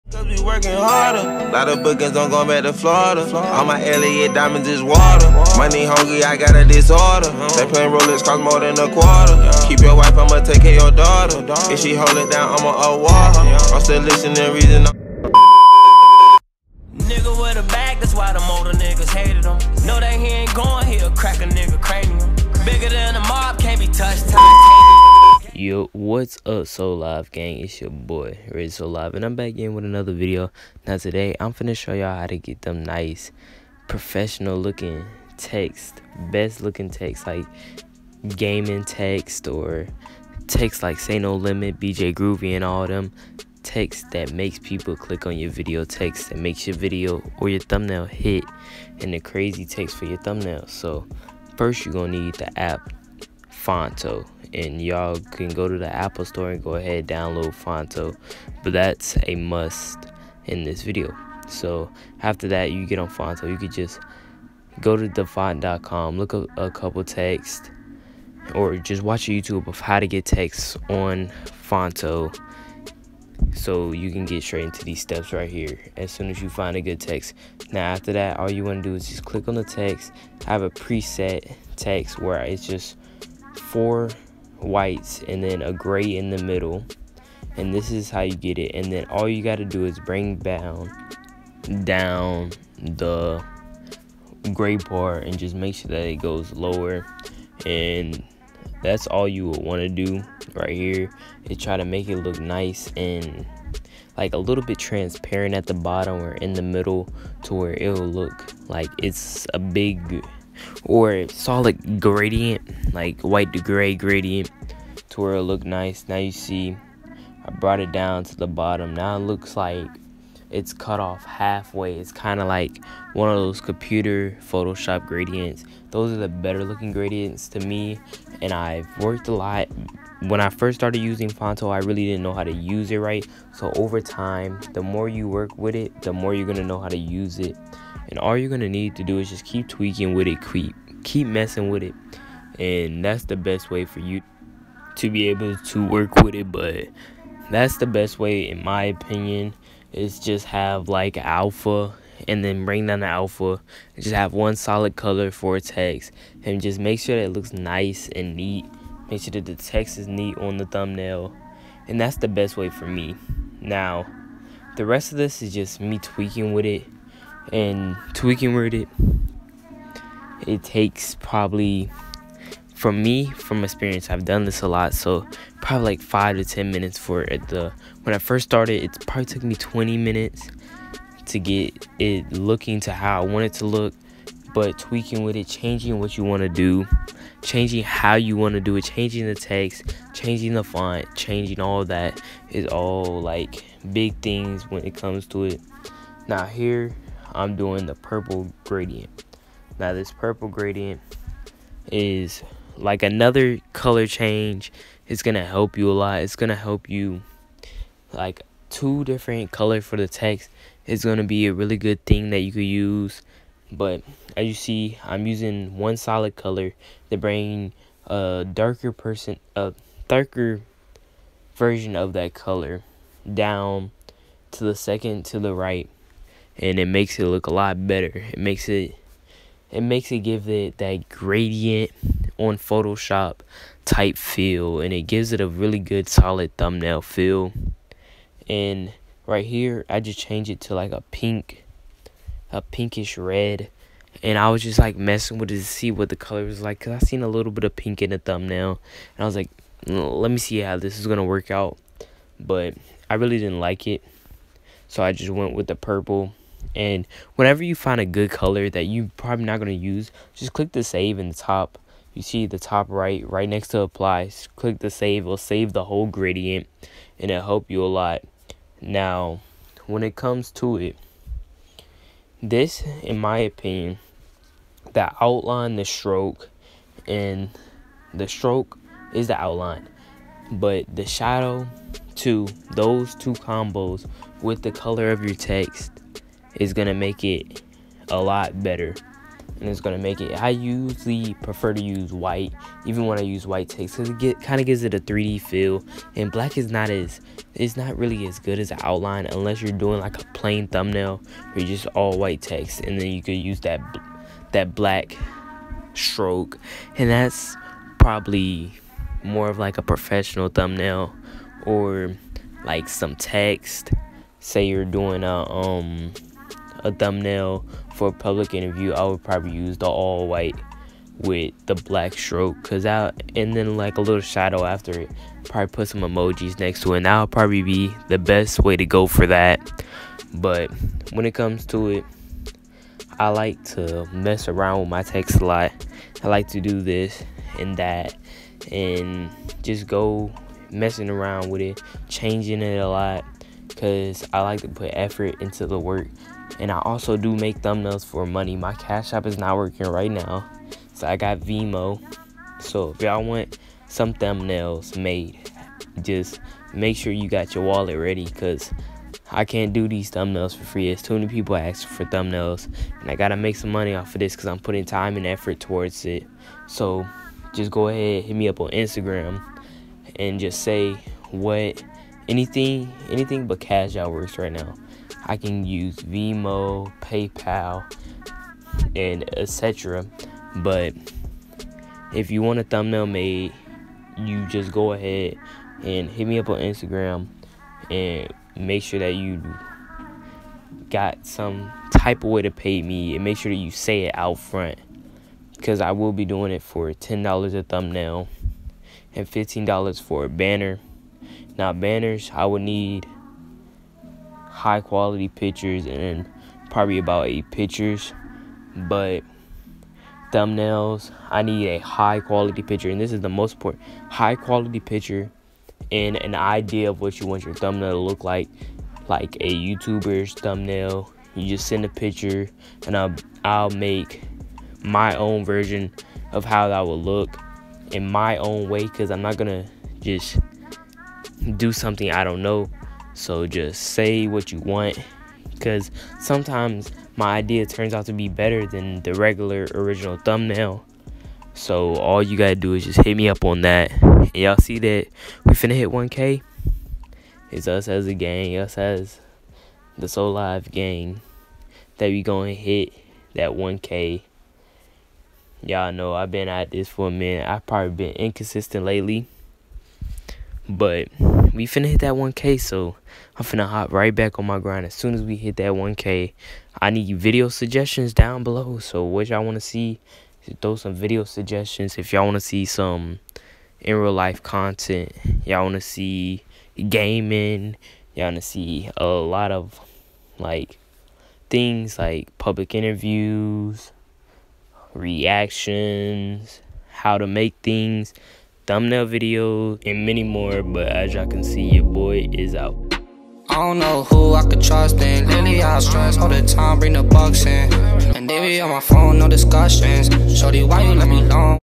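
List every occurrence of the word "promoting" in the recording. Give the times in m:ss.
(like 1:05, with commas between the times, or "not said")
not said.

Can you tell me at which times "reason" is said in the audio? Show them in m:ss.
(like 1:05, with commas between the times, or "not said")
0:14.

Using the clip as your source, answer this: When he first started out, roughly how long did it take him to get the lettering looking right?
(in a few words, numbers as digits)
20 minutes.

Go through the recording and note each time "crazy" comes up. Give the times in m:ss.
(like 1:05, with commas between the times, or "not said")
0:49.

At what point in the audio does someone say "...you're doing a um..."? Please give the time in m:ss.
5:14.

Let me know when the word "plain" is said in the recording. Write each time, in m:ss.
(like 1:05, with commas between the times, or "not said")
5:00.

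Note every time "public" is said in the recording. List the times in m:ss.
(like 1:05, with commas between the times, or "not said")
5:18, 8:02.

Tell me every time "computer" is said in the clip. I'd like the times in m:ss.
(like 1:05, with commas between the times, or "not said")
2:03.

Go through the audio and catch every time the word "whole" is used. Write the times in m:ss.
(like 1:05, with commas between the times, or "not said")
4:25.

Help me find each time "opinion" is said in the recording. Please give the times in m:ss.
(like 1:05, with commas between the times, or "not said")
2:28, 4:33.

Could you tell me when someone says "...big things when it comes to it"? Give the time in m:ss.
3:13.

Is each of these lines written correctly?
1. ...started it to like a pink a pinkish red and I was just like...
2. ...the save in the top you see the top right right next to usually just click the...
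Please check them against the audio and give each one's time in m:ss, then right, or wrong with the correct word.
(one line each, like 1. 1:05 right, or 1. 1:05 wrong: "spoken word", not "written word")
1. 4:00 wrong: "changed", not "started"
2. 4:20 wrong: "apply", not "usually".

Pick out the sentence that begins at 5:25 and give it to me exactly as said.
Probably put some emojis next to it.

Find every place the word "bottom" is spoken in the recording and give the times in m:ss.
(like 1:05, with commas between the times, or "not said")
1:45, 1:58.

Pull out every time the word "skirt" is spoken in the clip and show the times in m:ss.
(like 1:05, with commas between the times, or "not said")
not said.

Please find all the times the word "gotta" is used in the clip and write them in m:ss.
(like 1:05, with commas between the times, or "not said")
6:03, 7:22.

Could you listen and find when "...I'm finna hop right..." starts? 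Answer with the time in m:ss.
7:43.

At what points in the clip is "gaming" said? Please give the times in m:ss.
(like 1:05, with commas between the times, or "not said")
0:38, 7:56.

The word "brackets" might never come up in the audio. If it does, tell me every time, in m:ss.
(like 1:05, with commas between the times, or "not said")
not said.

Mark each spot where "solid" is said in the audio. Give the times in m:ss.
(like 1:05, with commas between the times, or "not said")
1:51, 2:34, 3:35, 3:56.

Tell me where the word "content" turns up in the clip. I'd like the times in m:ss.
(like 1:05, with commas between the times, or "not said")
7:54.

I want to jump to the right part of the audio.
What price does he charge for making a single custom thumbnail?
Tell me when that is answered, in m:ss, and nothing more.
6:36.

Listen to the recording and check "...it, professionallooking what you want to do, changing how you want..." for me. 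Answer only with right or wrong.
wrong.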